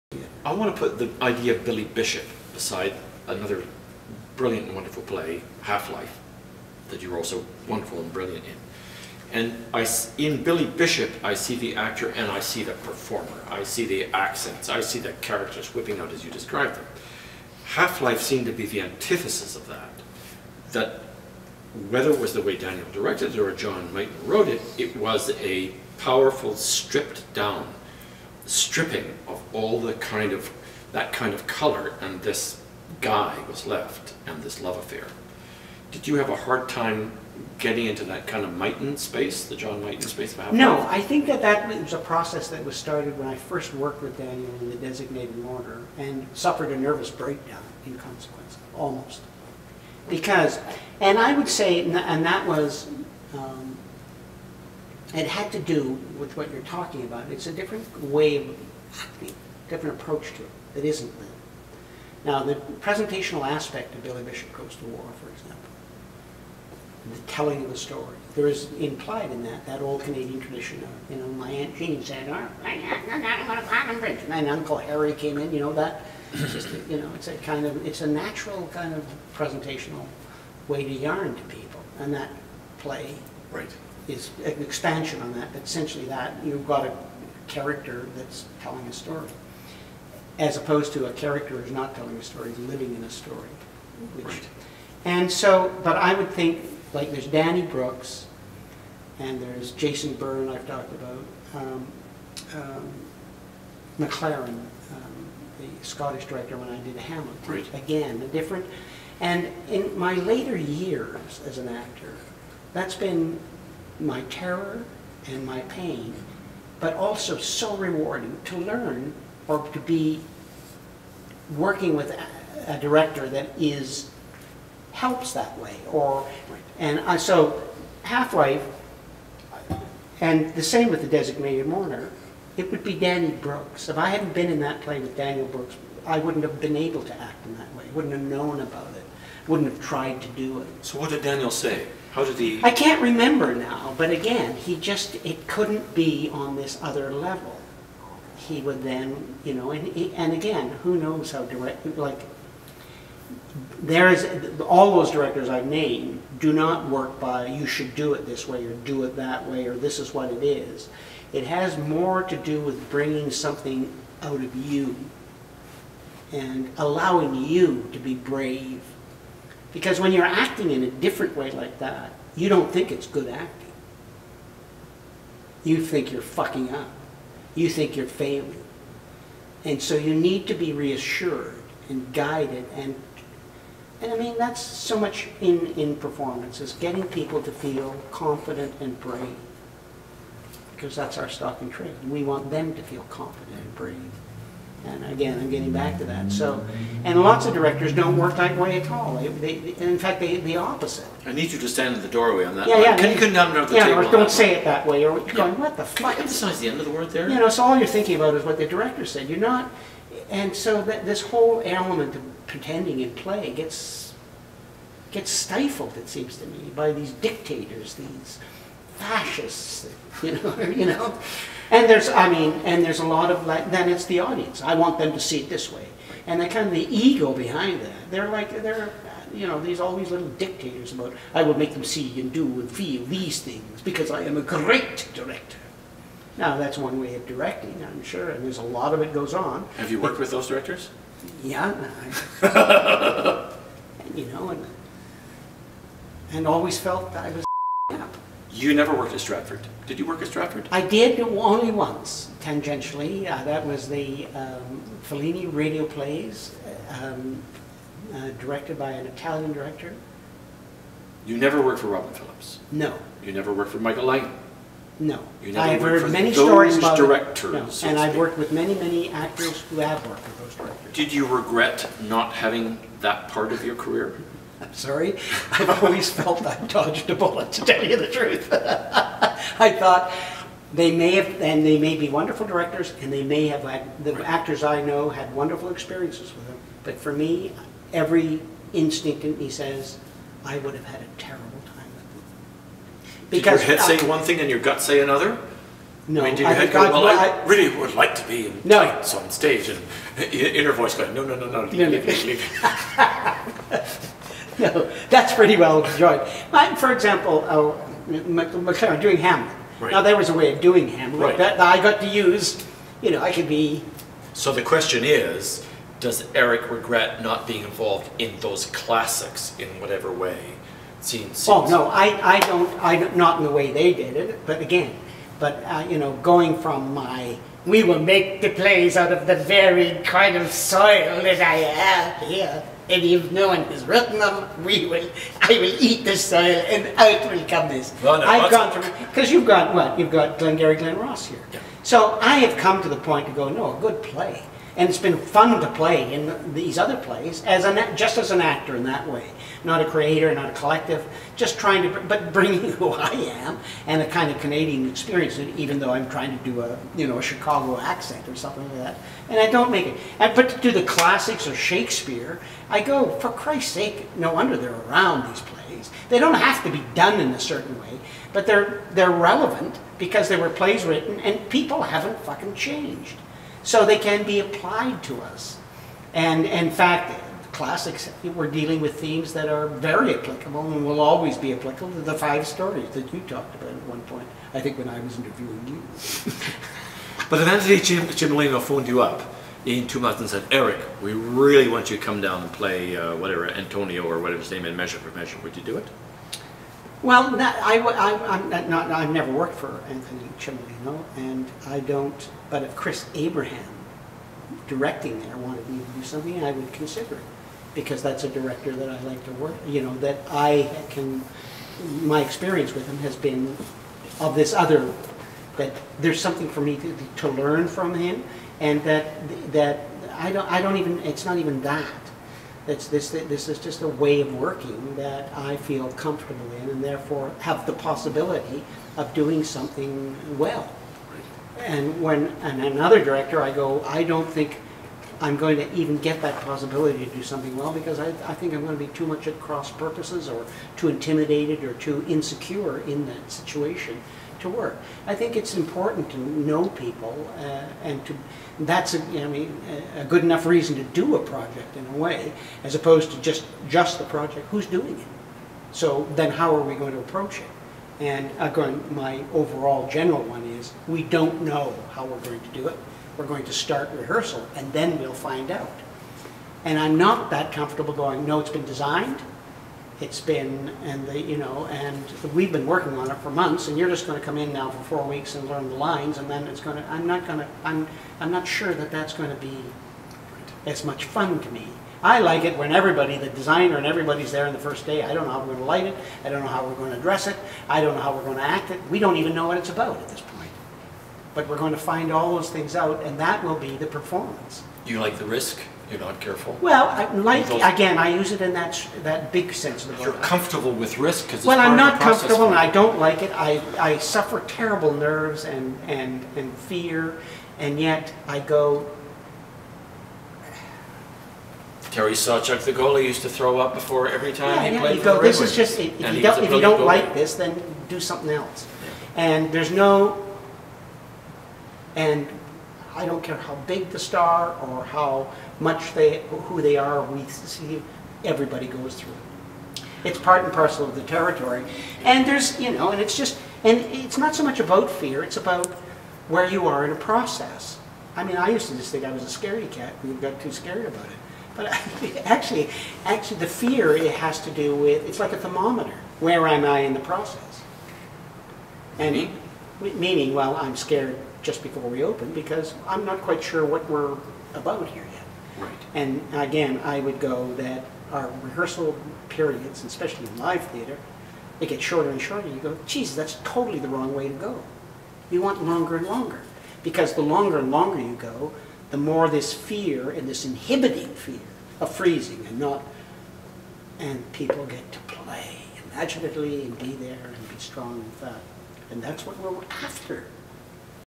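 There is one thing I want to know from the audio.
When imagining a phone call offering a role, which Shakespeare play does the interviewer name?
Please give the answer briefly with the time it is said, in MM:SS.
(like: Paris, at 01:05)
Measure for Measure, at 06:34.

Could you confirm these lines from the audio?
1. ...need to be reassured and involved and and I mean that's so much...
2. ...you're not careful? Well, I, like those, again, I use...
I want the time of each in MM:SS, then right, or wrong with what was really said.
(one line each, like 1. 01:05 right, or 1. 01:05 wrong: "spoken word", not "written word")
1. 03:00 wrong: "guided", not "involved"
2. 08:15 right.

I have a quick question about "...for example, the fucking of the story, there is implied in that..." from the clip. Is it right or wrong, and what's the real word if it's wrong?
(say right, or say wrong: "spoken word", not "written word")
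wrong: "telling", not "fucking".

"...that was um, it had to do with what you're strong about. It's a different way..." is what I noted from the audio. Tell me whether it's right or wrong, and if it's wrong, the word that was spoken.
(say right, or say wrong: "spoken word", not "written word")
wrong: "talking", not "strong".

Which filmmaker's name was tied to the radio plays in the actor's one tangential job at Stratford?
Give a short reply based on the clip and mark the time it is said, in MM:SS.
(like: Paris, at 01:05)
Fellini, at 04:15.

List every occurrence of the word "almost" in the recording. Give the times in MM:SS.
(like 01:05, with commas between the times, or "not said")
00:48.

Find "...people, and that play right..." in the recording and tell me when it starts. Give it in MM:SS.
01:21.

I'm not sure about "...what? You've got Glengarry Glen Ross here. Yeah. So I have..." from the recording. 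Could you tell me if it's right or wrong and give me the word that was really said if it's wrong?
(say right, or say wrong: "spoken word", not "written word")
right.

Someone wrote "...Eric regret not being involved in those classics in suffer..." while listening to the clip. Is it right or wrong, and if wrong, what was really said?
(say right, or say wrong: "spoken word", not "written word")
wrong: "whatever", not "suffer".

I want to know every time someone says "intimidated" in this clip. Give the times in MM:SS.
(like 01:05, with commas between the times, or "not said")
07:20.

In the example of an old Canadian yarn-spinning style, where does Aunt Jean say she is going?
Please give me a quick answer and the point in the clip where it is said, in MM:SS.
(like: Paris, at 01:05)
Platinum Bridge, at 01:13.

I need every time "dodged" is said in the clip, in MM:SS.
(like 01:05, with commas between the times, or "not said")
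04:36.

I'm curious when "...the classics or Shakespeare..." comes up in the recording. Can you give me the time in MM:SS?
06:00.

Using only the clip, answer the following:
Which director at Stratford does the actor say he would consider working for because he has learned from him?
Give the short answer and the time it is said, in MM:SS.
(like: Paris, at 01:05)
Chris Abraham, at 06:42.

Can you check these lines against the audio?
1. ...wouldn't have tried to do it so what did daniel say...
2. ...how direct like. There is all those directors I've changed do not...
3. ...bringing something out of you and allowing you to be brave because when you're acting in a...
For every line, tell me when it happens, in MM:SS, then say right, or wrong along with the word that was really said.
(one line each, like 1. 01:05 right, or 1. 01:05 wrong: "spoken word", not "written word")
1. 02:19 right
2. 02:31 wrong: "named", not "changed"
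3. 02:42 right.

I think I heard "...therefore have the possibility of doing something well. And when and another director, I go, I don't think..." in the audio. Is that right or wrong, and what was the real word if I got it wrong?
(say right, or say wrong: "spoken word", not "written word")
right.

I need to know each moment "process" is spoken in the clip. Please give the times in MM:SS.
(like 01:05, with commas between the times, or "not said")
00:41, 08:56, 09:06.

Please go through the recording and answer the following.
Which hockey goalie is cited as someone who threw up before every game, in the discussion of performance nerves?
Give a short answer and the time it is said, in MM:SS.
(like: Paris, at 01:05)
Terry Sawchuk, at 08:31.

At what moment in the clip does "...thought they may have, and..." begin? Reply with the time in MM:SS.
04:39.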